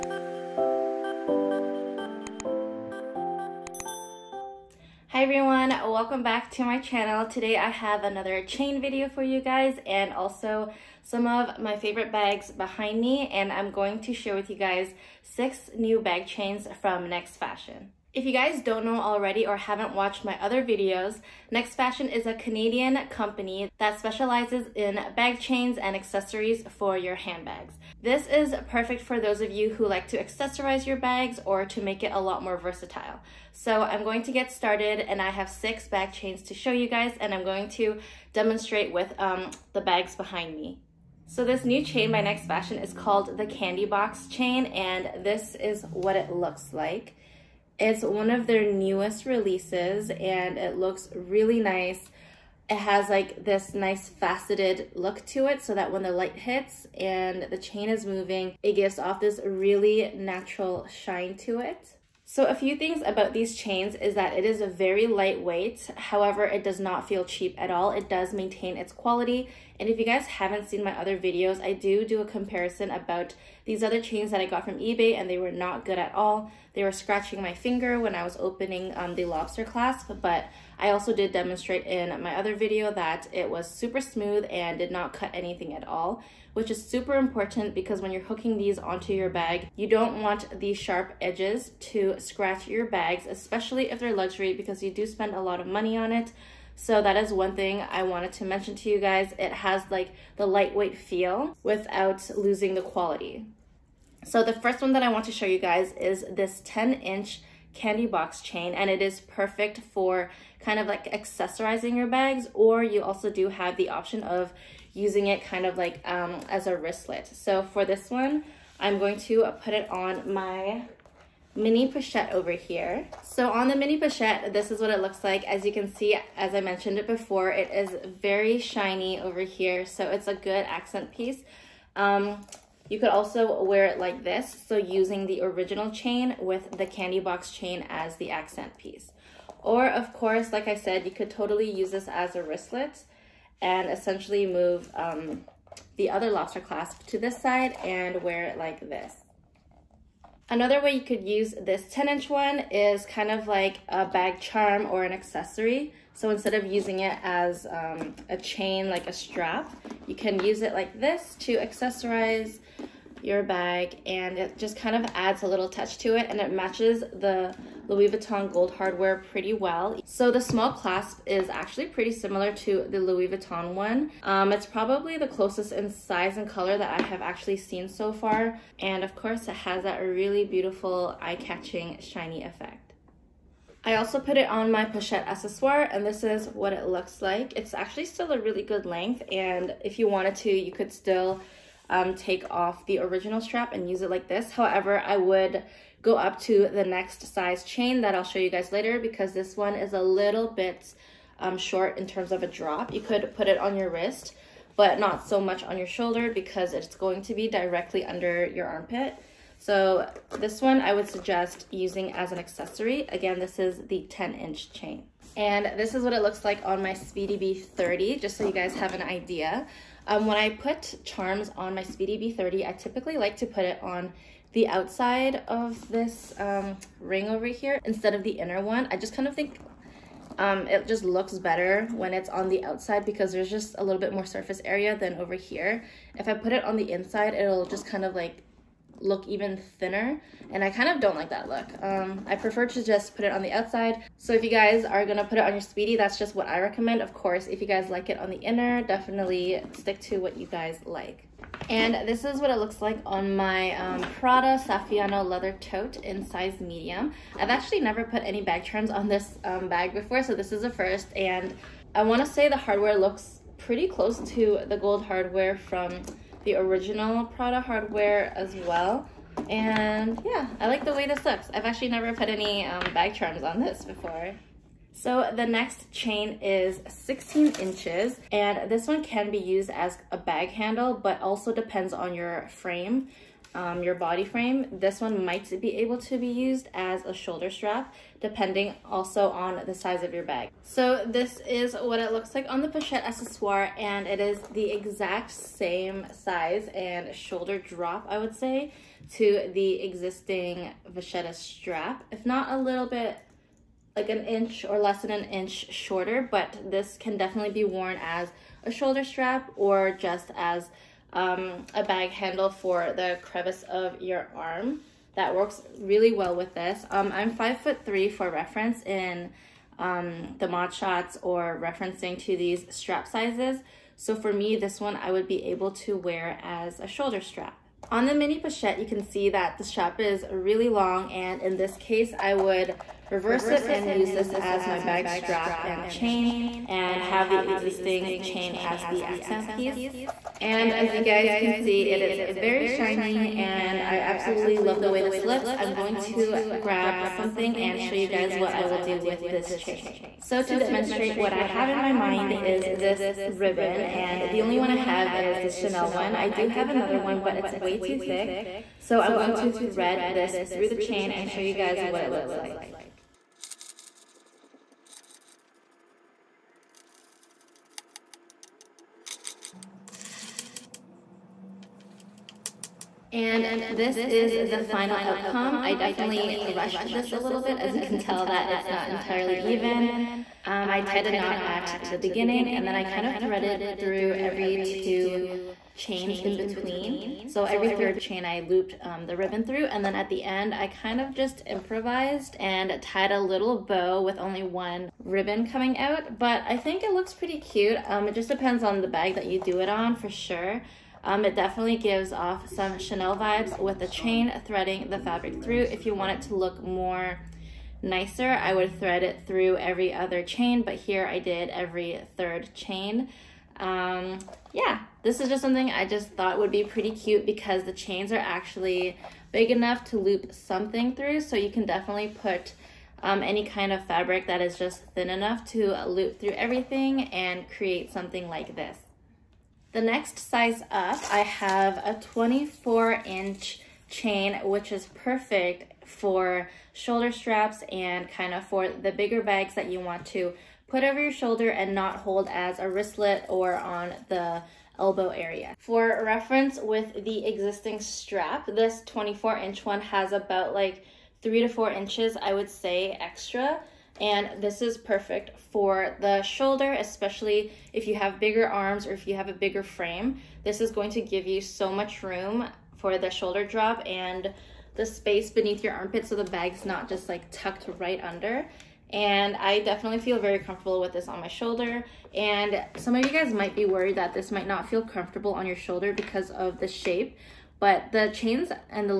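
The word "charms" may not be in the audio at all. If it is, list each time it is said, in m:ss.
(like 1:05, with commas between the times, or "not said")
2:34, 3:41, 4:33.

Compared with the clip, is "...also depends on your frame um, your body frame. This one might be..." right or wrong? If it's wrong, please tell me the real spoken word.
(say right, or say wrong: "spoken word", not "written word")
right.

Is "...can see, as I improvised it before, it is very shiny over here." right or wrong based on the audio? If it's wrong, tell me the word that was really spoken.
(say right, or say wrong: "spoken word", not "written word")
wrong: "mentioned", not "improvised".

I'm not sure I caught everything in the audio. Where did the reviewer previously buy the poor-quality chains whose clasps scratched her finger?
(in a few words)
eBay.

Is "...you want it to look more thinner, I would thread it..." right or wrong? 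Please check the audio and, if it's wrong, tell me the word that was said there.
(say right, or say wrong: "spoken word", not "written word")
wrong: "nicer", not "thinner".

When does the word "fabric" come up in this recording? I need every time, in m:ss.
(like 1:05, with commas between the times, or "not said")
6:44, 7:03.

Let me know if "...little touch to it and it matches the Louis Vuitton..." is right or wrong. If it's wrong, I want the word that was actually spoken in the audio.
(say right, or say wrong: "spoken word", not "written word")
right.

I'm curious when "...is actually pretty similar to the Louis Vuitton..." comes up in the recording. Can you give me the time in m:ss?
2:51.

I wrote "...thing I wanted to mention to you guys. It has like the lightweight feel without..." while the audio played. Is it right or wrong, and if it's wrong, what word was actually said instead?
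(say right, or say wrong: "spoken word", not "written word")
right.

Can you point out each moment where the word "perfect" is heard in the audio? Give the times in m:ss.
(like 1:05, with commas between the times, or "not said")
0:28, 1:49, 7:14, 7:34.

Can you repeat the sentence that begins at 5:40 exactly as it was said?
And as you guys can see, it is very shiny and I absolutely love the way this looks.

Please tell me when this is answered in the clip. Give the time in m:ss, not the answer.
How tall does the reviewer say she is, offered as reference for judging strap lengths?
5:17.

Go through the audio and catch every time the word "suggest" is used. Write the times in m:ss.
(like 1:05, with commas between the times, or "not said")
3:31.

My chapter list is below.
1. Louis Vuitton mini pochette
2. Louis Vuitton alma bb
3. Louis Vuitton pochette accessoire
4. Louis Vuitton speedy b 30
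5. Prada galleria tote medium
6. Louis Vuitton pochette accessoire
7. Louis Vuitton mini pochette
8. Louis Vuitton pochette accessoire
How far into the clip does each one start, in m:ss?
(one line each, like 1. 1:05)
1. 2:02
2. 2:29
3. 3:03
4. 3:34
5. 4:10
6. 4:49
7. 5:27
8. 7:25.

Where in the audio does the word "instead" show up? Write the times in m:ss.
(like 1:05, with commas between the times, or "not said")
2:36, 3:47.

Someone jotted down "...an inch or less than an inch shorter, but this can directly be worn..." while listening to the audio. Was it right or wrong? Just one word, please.
wrong.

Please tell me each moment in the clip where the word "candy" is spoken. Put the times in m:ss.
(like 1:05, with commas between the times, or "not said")
0:43, 1:47, 2:16.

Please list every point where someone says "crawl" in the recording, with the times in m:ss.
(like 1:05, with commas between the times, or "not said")
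not said.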